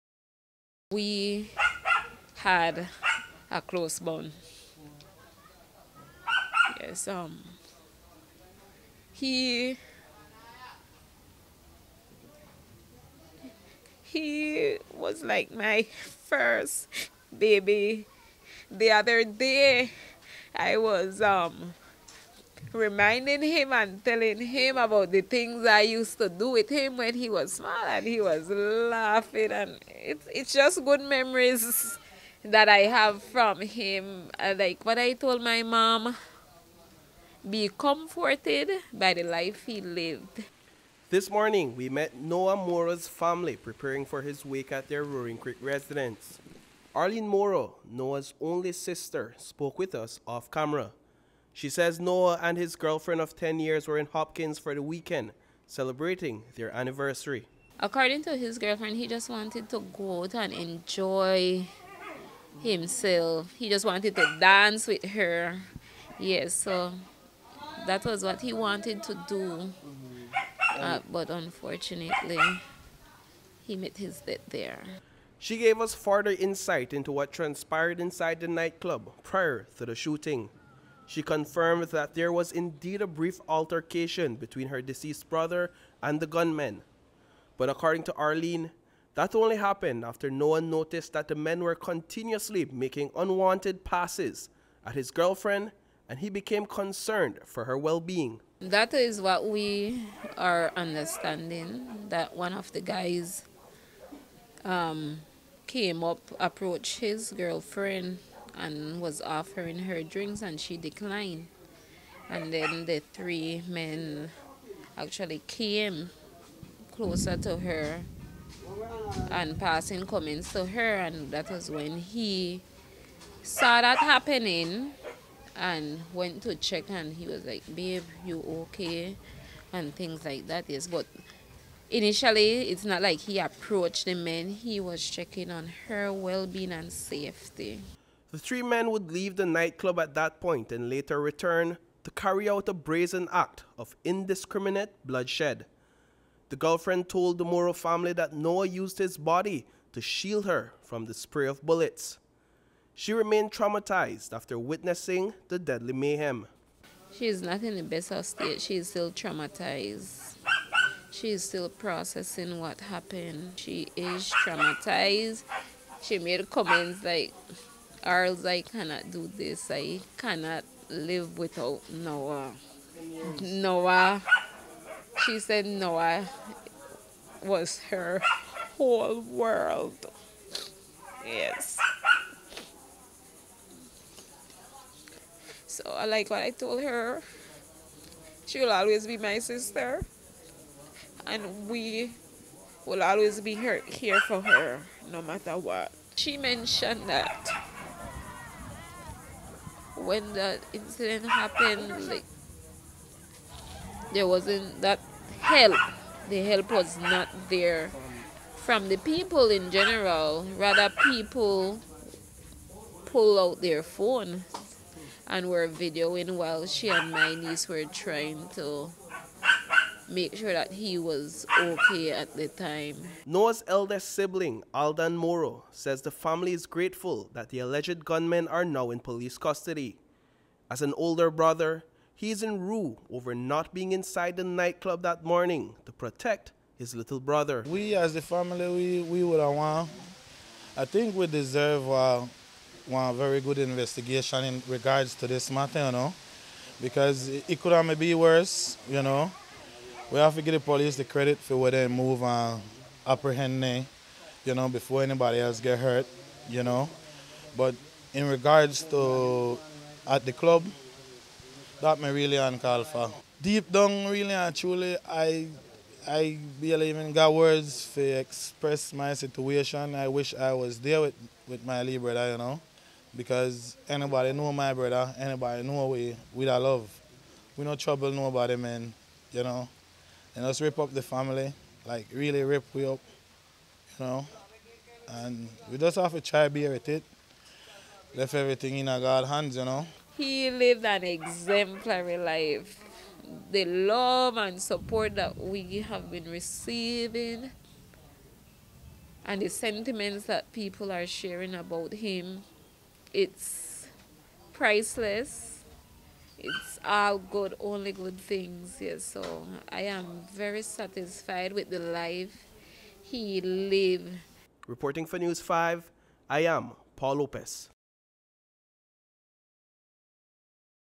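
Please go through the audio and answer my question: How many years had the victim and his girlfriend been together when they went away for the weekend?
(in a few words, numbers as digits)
10.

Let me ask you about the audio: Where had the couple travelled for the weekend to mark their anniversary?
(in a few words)
Hopkins.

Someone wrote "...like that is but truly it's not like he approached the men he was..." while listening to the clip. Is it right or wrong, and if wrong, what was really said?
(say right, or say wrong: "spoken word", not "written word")
wrong: "initially", not "truly".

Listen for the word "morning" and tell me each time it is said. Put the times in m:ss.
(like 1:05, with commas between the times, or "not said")
0:41, 3:55.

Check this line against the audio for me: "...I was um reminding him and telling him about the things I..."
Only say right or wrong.
right.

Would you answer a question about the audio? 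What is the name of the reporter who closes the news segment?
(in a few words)
Paul Lopez.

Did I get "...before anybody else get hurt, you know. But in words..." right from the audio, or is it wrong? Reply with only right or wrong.
wrong.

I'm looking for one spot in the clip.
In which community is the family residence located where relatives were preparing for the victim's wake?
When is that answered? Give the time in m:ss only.
0:45.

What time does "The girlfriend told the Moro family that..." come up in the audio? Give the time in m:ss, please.
2:26.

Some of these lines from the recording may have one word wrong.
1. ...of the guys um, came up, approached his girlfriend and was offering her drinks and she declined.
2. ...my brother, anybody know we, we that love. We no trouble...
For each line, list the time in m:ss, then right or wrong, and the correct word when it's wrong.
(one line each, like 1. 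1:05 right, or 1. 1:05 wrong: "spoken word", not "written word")
1. 1:42 right
2. 4:34 right.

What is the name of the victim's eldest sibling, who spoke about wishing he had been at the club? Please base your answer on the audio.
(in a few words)
Aldan Moro.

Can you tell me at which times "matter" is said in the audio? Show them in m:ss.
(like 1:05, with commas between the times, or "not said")
3:15, 4:05.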